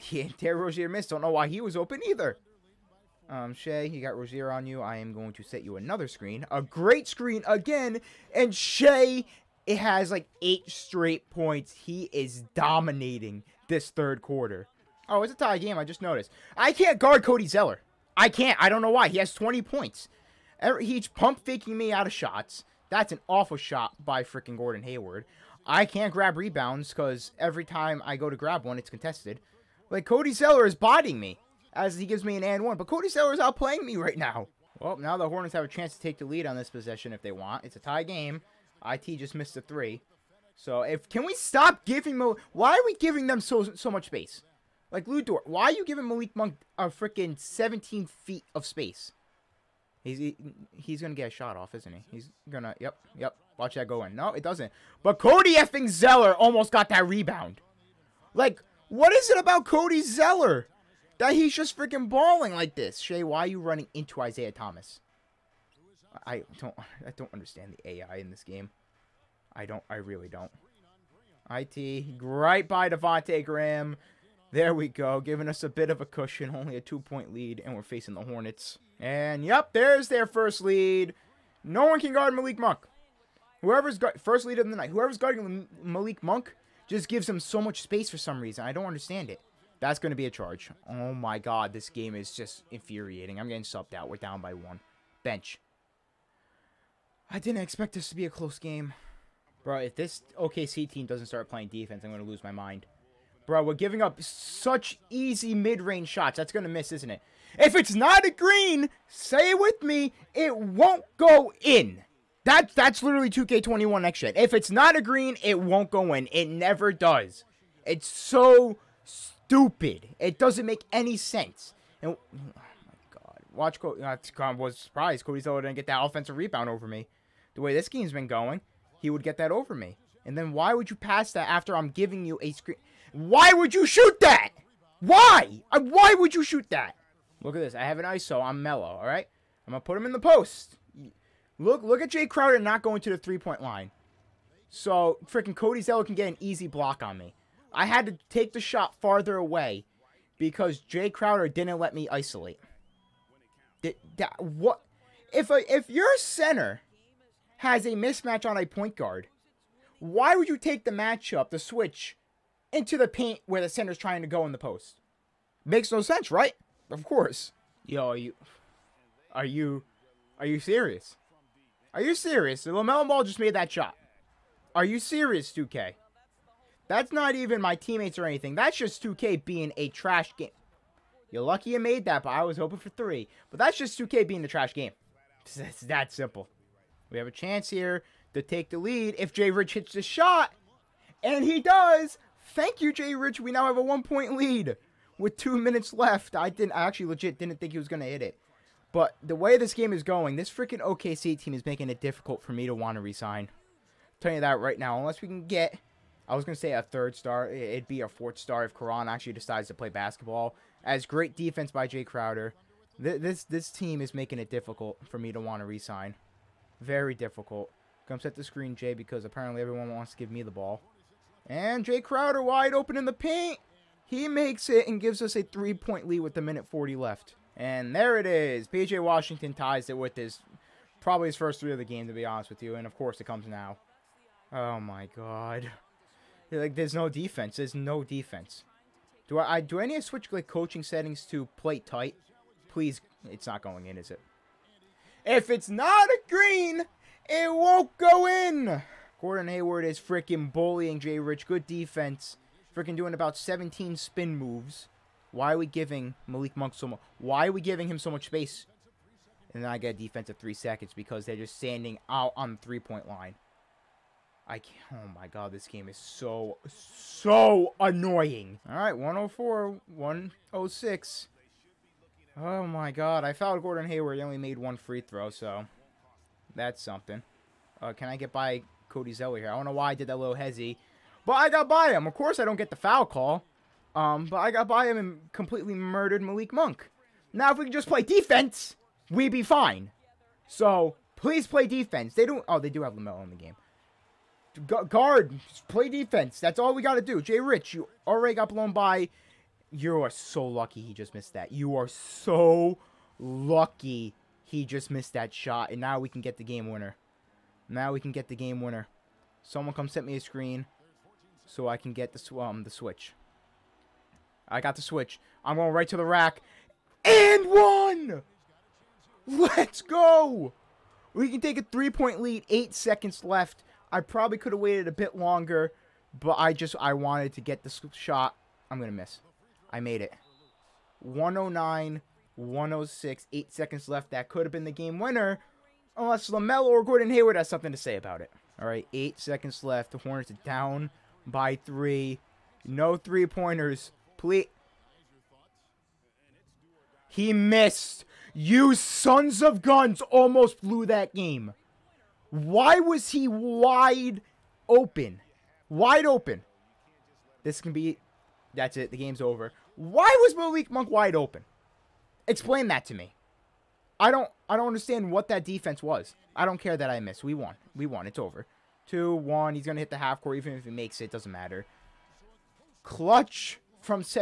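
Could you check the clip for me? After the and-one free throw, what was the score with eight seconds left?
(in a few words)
109-106.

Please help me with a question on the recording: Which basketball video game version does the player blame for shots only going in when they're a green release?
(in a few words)
2K21 next gen.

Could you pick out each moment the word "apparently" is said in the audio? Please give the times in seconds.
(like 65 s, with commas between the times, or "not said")
219 s.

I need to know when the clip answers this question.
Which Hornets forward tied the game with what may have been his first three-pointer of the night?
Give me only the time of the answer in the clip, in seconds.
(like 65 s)
228 s.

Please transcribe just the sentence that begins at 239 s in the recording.
Do I, I do any switch like coaching settings to play tight?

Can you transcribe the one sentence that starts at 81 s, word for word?
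No one can guard Malik Monk.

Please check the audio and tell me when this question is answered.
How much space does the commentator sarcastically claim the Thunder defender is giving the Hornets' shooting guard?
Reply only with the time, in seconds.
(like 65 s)
47 s.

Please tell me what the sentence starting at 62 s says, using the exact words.
Shai, why are you running into Isaiah Thomas?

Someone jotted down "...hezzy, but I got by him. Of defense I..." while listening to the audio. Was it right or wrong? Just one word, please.
wrong.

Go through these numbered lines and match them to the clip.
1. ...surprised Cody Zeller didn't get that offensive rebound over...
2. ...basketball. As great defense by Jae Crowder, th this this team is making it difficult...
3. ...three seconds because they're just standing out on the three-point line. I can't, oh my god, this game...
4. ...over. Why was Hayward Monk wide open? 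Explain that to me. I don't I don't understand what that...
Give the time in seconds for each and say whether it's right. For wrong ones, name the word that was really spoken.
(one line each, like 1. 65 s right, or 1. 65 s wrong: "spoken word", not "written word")
1. 124 s right
2. 209 s right
3. 260 s right
4. 359 s wrong: "Malik", not "Hayward".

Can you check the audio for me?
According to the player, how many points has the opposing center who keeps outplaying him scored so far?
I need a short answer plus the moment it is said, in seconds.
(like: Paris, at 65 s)
20, at 19 s.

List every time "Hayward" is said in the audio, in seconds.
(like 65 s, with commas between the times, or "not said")
24 s, 249 s, 273 s, 337 s.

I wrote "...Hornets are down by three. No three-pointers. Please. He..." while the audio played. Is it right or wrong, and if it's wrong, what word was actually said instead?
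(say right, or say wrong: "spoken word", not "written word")
right.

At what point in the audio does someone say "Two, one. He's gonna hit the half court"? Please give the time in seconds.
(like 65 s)
368 s.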